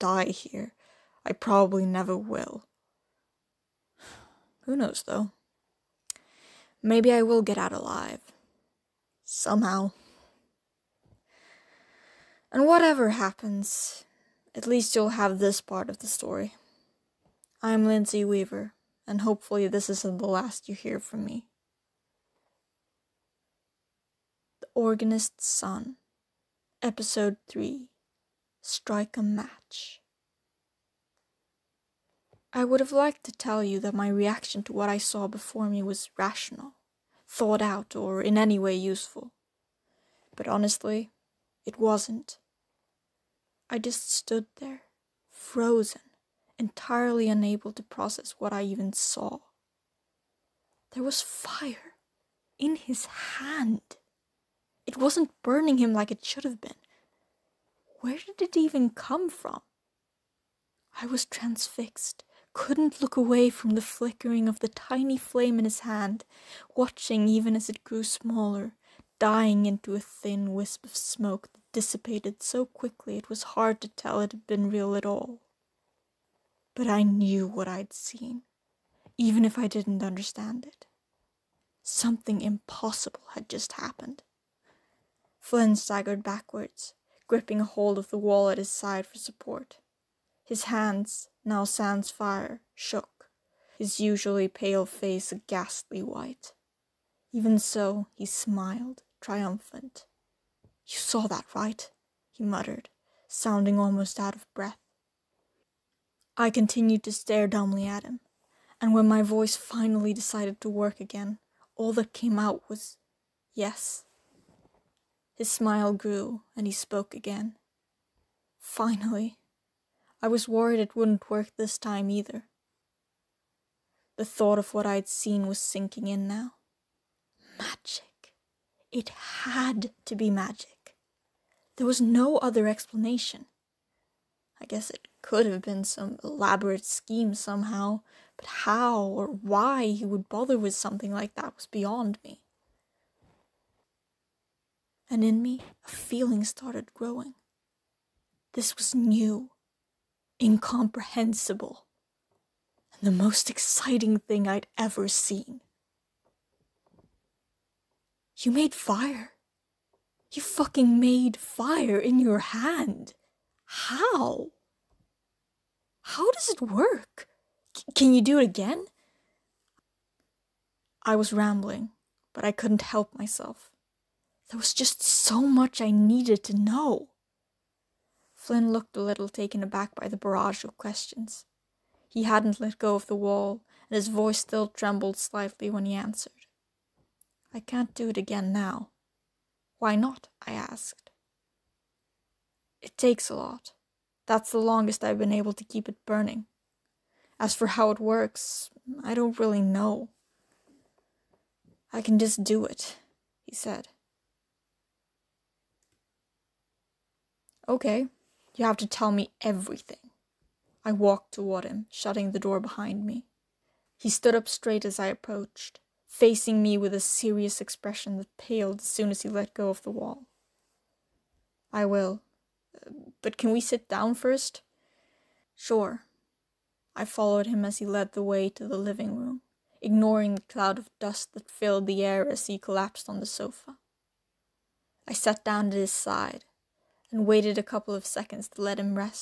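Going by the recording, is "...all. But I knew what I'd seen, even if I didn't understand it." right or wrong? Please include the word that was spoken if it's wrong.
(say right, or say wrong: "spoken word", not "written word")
right.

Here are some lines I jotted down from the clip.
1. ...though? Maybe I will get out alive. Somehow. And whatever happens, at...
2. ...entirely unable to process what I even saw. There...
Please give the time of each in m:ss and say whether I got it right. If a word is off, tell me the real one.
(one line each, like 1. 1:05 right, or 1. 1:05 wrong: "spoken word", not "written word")
1. 0:05 right
2. 0:46 right.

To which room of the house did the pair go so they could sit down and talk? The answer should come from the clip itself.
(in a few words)
The living room.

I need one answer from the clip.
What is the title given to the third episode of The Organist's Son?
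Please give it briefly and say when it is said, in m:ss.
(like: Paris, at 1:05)
Strike a Match, at 0:28.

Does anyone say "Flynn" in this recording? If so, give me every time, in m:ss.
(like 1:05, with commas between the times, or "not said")
1:25, 2:58.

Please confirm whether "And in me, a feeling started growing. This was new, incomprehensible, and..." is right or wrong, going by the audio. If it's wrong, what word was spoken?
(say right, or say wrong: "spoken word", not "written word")
right.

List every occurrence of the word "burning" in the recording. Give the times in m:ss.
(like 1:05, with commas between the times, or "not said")
0:55, 3:16.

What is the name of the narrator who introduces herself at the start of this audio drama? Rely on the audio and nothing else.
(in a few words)
Lindsay Weaver.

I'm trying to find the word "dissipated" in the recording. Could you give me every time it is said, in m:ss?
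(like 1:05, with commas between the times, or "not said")
1:11.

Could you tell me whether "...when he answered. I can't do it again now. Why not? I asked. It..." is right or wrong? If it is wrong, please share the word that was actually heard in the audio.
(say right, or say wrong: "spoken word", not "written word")
right.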